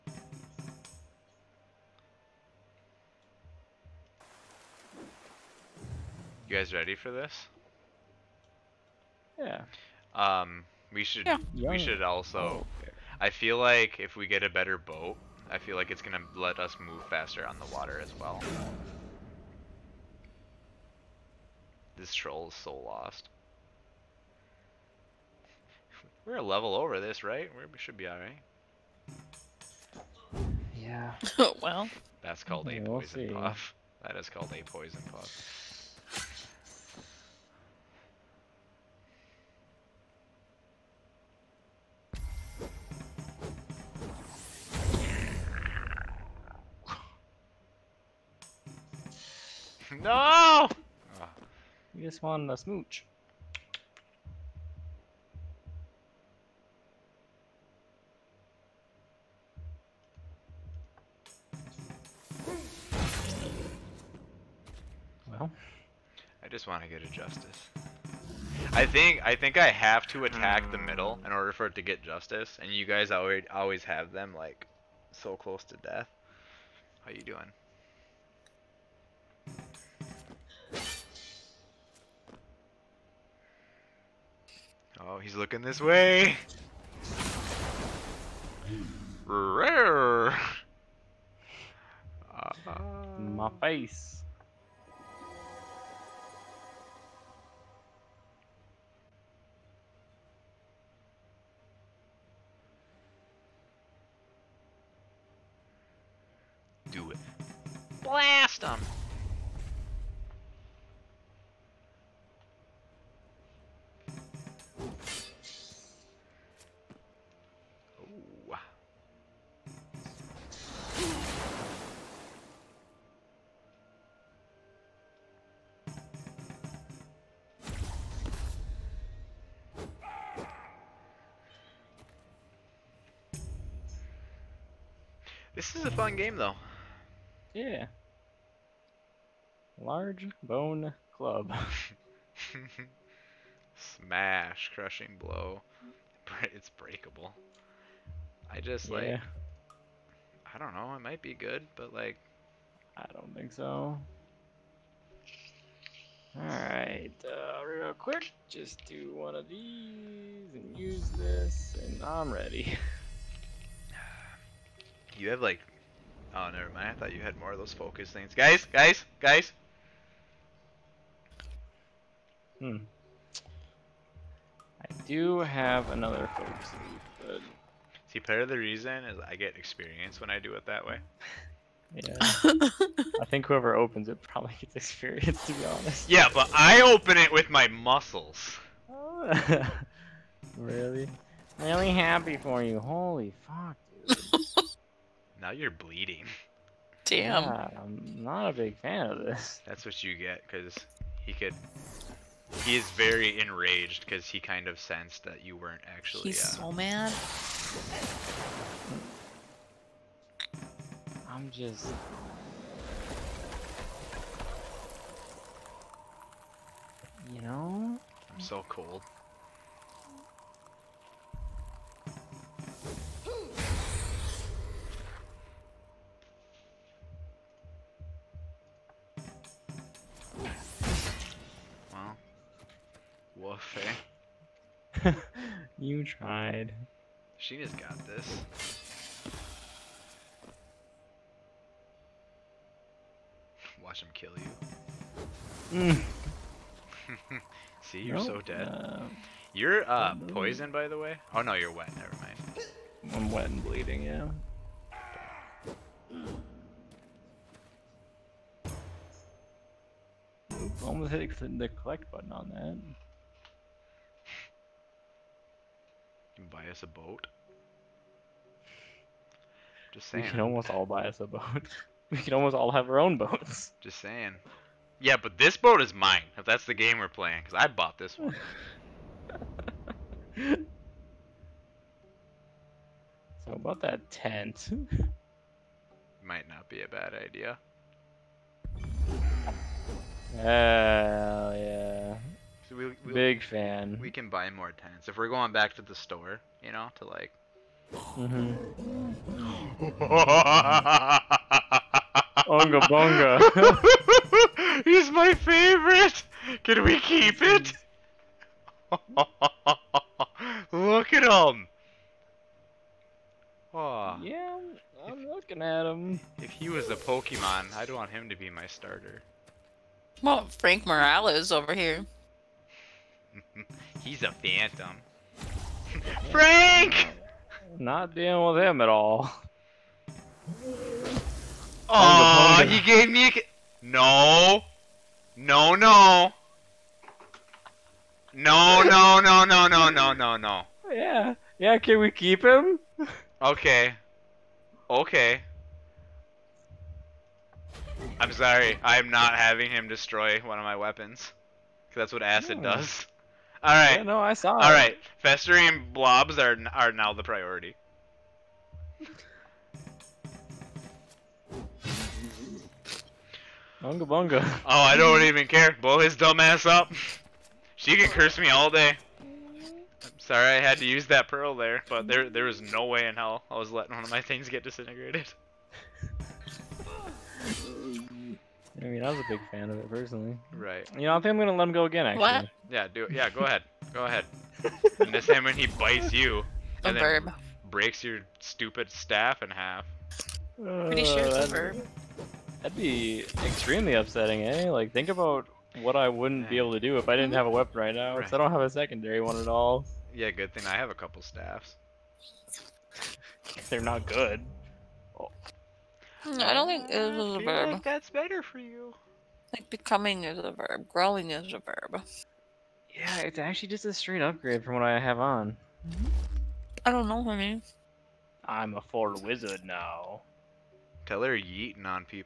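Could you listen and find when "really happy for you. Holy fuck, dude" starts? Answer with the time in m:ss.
3:11.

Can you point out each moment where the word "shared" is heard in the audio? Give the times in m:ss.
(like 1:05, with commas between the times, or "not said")
not said.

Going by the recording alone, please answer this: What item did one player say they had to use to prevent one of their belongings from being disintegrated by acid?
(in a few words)
pearl.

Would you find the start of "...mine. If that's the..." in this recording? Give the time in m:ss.
4:35.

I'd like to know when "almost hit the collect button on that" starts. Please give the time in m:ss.
4:20.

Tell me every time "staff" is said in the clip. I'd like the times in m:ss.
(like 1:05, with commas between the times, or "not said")
6:28, 6:41.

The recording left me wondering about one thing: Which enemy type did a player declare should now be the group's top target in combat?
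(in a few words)
Festering blobs.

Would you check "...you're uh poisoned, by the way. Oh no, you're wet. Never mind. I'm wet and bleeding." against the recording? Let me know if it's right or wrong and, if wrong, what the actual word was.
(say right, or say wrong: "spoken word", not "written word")
right.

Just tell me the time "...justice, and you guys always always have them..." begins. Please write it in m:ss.
1:12.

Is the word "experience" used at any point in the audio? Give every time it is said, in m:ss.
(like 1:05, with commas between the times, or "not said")
2:59, 3:04.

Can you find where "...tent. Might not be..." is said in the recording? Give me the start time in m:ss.
4:44.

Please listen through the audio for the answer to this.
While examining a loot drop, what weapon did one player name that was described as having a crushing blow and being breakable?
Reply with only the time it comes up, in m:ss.
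2:19.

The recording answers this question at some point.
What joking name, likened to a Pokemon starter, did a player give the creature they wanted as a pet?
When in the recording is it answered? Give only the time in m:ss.
5:20.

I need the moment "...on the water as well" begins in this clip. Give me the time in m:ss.
0:17.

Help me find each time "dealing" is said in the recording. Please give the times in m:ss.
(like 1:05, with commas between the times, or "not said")
5:28.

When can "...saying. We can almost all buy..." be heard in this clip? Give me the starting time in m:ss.
4:30.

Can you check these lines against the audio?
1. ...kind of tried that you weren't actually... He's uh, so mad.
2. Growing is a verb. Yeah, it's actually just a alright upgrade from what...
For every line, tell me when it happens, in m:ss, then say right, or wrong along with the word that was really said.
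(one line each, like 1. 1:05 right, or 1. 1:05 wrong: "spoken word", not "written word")
1. 3:24 wrong: "sensed", not "tried"
2. 6:50 wrong: "straight", not "alright".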